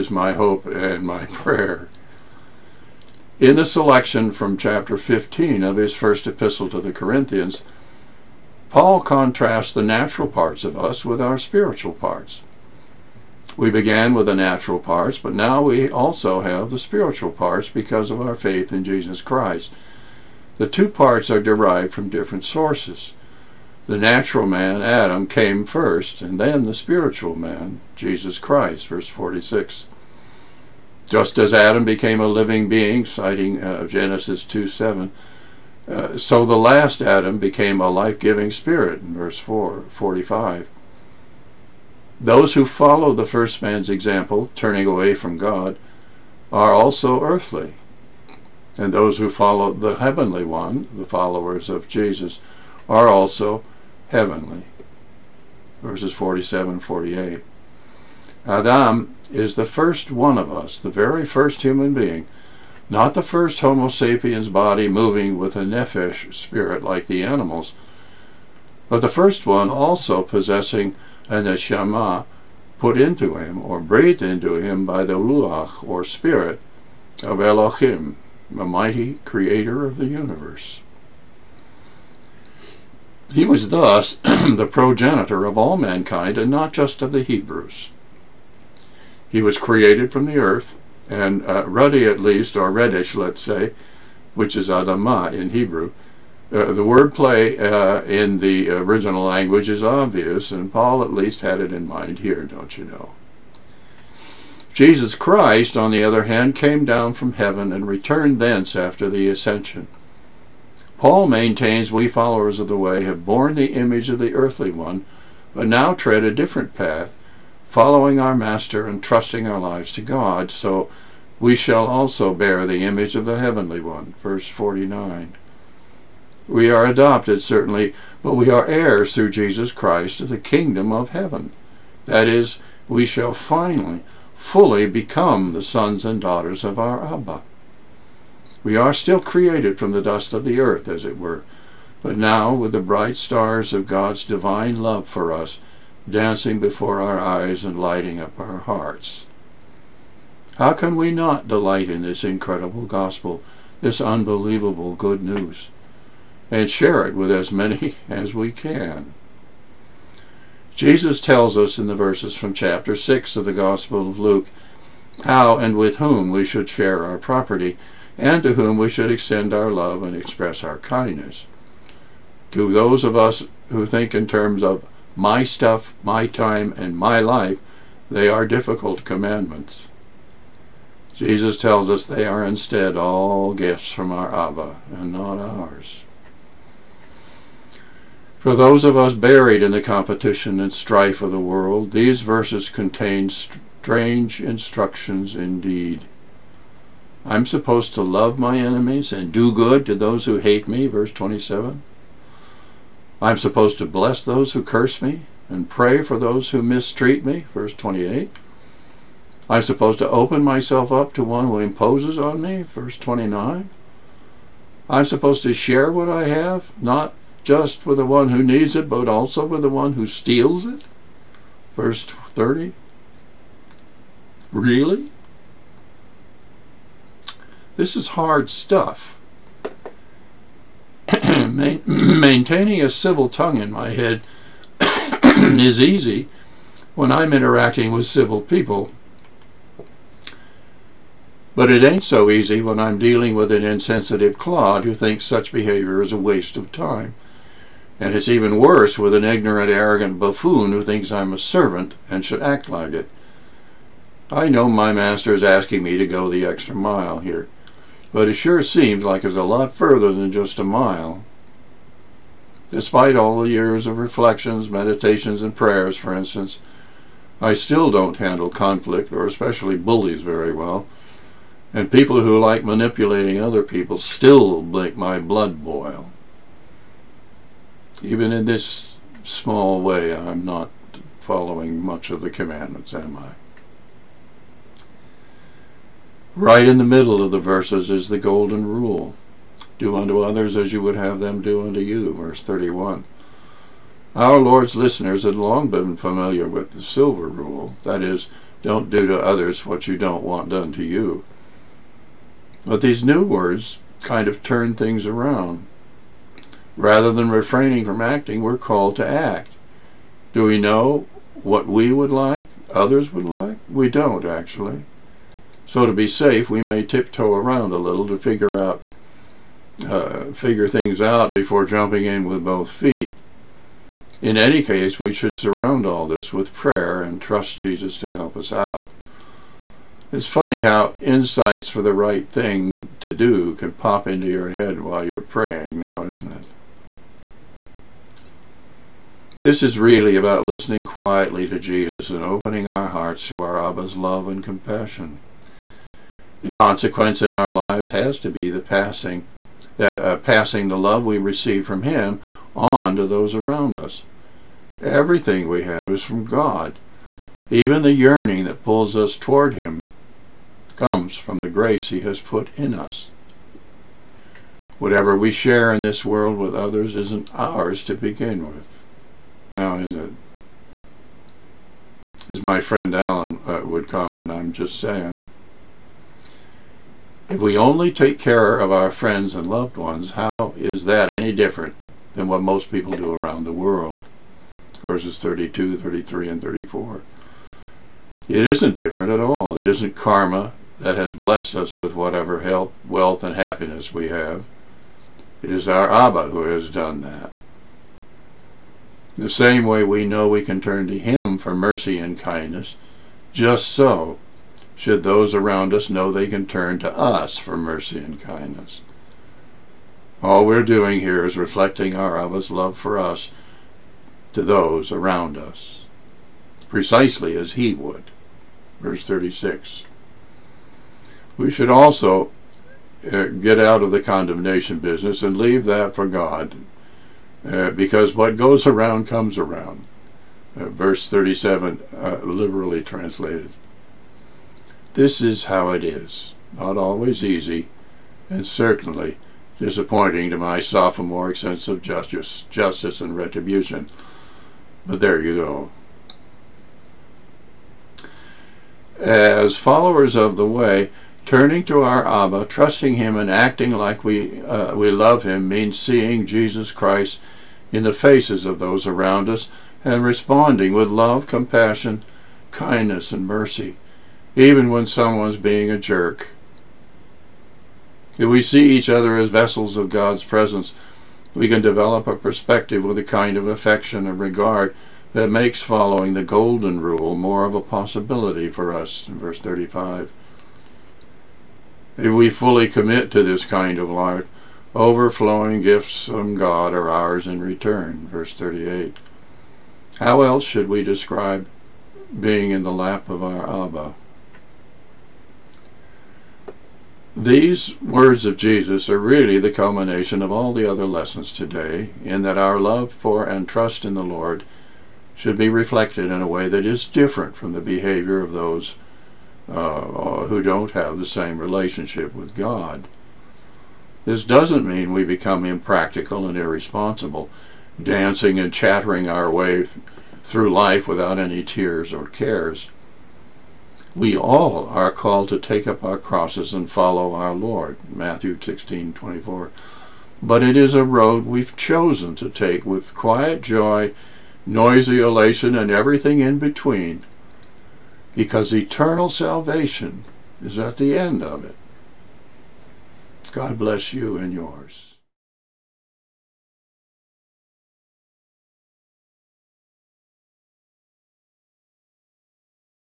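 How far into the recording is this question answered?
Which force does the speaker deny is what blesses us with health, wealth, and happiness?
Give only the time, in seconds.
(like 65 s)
389 s.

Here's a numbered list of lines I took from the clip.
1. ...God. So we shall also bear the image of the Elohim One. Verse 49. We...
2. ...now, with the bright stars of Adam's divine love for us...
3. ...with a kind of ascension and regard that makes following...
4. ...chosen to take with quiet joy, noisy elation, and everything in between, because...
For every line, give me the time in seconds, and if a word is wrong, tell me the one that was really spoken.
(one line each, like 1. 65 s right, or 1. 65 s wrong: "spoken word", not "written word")
1. 120 s wrong: "Heavenly", not "Elohim"
2. 142 s wrong: "God", not "Adam"
3. 472 s wrong: "affection", not "ascension"
4. 531 s right.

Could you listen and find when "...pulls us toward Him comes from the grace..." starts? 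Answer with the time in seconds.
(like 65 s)
358 s.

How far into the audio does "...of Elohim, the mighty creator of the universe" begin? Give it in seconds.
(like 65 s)
77 s.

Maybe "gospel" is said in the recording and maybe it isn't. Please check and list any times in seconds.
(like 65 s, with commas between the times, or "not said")
152 s, 163 s.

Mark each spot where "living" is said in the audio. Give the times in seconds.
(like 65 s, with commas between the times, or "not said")
32 s.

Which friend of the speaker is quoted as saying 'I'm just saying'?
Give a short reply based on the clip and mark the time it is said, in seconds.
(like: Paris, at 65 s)
Alan, at 372 s.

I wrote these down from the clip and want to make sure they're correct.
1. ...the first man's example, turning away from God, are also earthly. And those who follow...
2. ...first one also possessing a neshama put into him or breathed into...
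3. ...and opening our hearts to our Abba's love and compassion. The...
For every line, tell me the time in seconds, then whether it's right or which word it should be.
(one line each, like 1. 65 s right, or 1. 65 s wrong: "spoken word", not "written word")
1. 43 s right
2. 69 s right
3. 342 s right.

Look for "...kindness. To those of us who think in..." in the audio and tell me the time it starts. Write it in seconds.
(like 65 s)
170 s.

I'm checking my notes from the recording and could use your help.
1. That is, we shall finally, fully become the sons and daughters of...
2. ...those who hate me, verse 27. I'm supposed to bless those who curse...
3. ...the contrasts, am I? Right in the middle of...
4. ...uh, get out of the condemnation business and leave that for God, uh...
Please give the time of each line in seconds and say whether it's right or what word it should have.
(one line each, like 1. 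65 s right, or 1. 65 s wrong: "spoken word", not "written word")
1. 132 s right
2. 199 s right
3. 282 s wrong: "commandments", not "contrasts"
4. 423 s right.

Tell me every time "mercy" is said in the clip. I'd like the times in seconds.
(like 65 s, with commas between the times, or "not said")
401 s, 407 s, 463 s.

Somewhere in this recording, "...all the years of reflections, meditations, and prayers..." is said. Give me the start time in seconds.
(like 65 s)
263 s.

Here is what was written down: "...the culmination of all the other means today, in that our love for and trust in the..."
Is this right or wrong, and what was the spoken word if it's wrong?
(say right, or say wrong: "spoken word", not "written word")
wrong: "lessons", not "means".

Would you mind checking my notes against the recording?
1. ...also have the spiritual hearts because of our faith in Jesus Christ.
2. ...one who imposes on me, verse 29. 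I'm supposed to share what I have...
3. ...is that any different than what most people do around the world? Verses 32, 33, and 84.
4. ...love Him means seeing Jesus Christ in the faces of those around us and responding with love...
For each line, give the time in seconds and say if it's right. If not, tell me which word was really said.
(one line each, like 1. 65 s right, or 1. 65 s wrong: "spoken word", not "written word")
1. 15 s wrong: "parts", not "hearts"
2. 211 s right
3. 380 s wrong: "34", not "84"
4. 454 s right.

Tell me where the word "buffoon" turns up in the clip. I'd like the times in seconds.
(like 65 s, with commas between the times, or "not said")
250 s.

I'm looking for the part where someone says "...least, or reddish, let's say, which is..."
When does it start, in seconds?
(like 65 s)
92 s.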